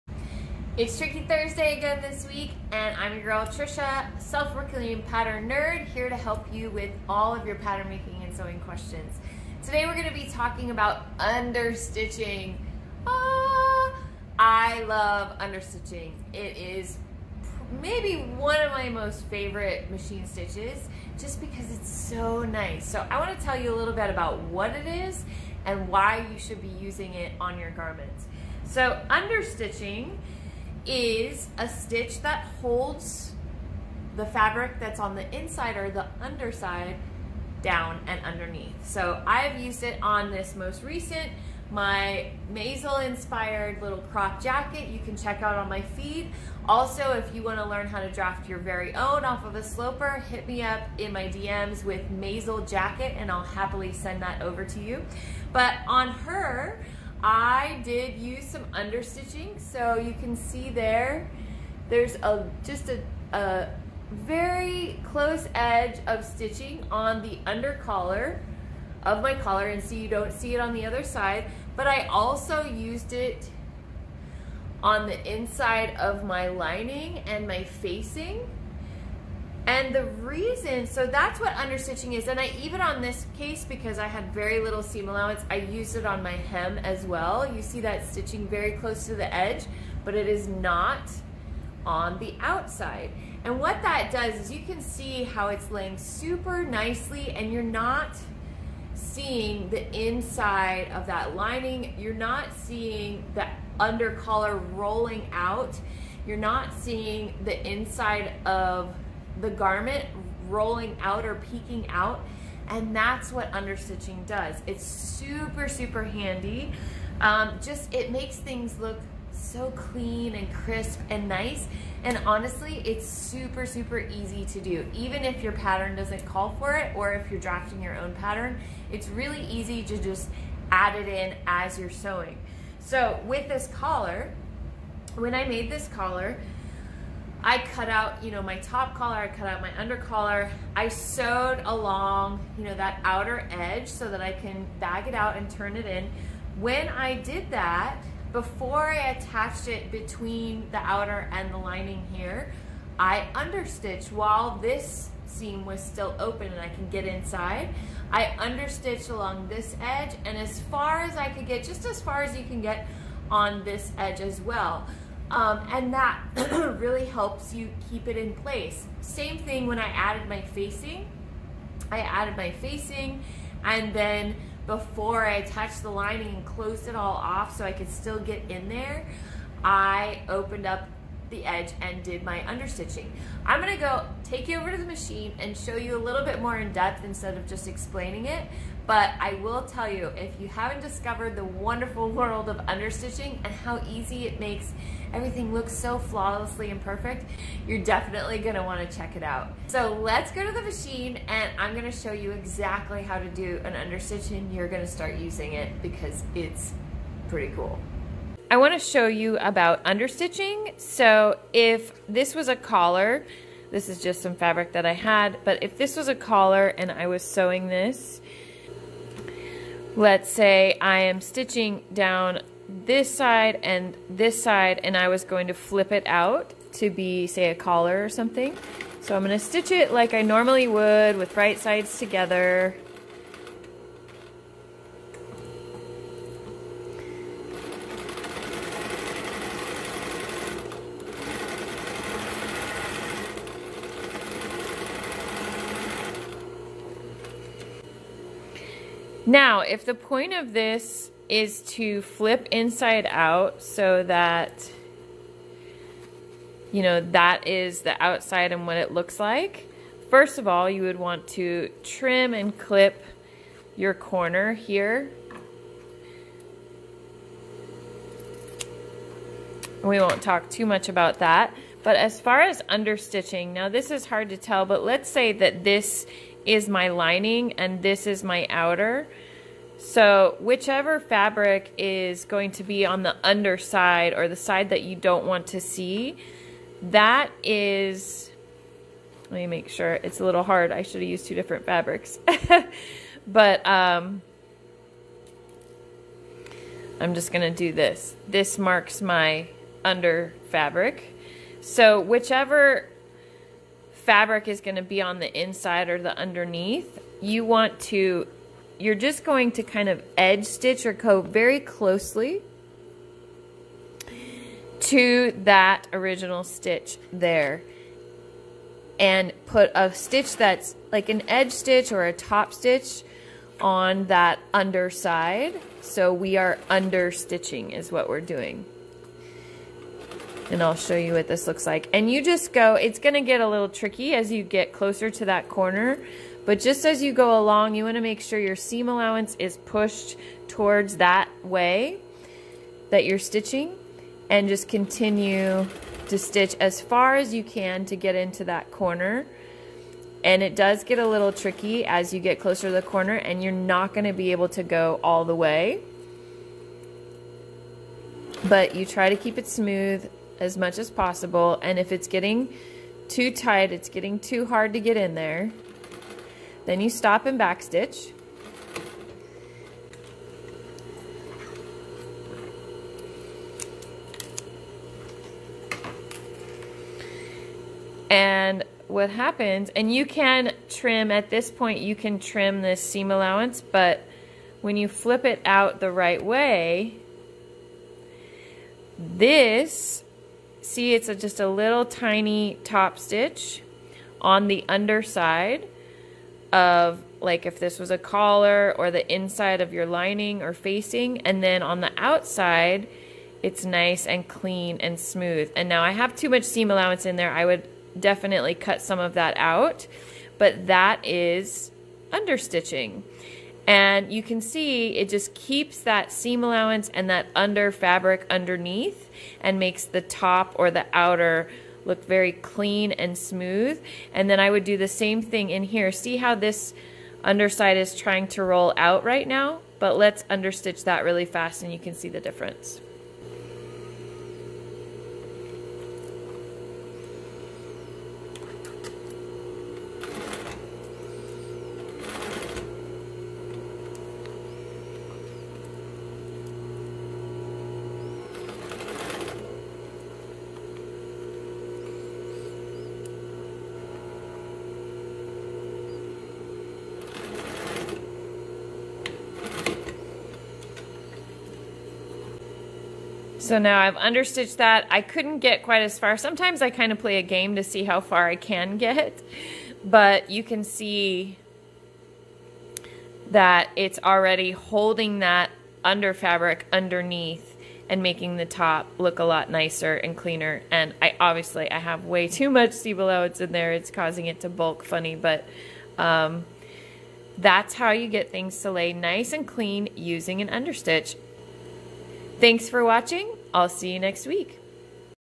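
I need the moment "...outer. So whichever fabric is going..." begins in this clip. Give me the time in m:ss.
4:38.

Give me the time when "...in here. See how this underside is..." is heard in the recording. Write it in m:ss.
7:05.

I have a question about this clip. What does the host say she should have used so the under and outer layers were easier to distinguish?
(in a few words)
Two different fabrics.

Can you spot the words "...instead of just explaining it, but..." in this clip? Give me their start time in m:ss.
3:07.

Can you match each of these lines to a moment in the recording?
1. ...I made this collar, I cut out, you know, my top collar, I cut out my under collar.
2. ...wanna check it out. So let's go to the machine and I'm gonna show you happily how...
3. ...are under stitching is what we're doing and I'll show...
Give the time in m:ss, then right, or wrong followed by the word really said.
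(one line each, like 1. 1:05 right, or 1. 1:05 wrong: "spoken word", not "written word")
1. 2:15 right
2. 3:18 wrong: "exactly", not "happily"
3. 5:26 right.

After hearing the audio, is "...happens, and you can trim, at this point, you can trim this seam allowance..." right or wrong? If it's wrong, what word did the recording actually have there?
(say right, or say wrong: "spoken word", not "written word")
right.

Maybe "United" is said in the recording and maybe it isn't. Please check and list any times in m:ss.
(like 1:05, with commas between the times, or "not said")
not said.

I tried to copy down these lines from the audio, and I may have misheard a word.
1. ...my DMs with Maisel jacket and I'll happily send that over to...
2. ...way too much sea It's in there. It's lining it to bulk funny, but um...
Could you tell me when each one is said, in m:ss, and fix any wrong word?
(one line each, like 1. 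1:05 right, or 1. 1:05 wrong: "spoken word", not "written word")
1. 0:51 right
2. 8:02 wrong: "causing", not "lining".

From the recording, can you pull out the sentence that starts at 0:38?
So I've used it on this most recent, my Maisel inspired little crop jacket you can check out on my feed.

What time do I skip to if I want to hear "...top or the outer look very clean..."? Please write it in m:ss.
7:00.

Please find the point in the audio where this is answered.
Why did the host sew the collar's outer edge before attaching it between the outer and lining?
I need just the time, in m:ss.
2:24.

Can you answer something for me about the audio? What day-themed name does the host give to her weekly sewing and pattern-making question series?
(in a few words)
Tricky Thursday.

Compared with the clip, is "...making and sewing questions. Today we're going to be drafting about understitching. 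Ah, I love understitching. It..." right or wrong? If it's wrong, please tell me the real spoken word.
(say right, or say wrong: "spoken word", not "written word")
wrong: "talking", not "drafting".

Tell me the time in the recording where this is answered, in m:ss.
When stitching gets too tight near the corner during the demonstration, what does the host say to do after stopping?
6:07.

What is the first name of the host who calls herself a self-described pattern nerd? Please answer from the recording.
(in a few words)
Tricia.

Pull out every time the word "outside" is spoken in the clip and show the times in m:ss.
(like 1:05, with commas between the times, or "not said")
1:32, 4:18, 6:41.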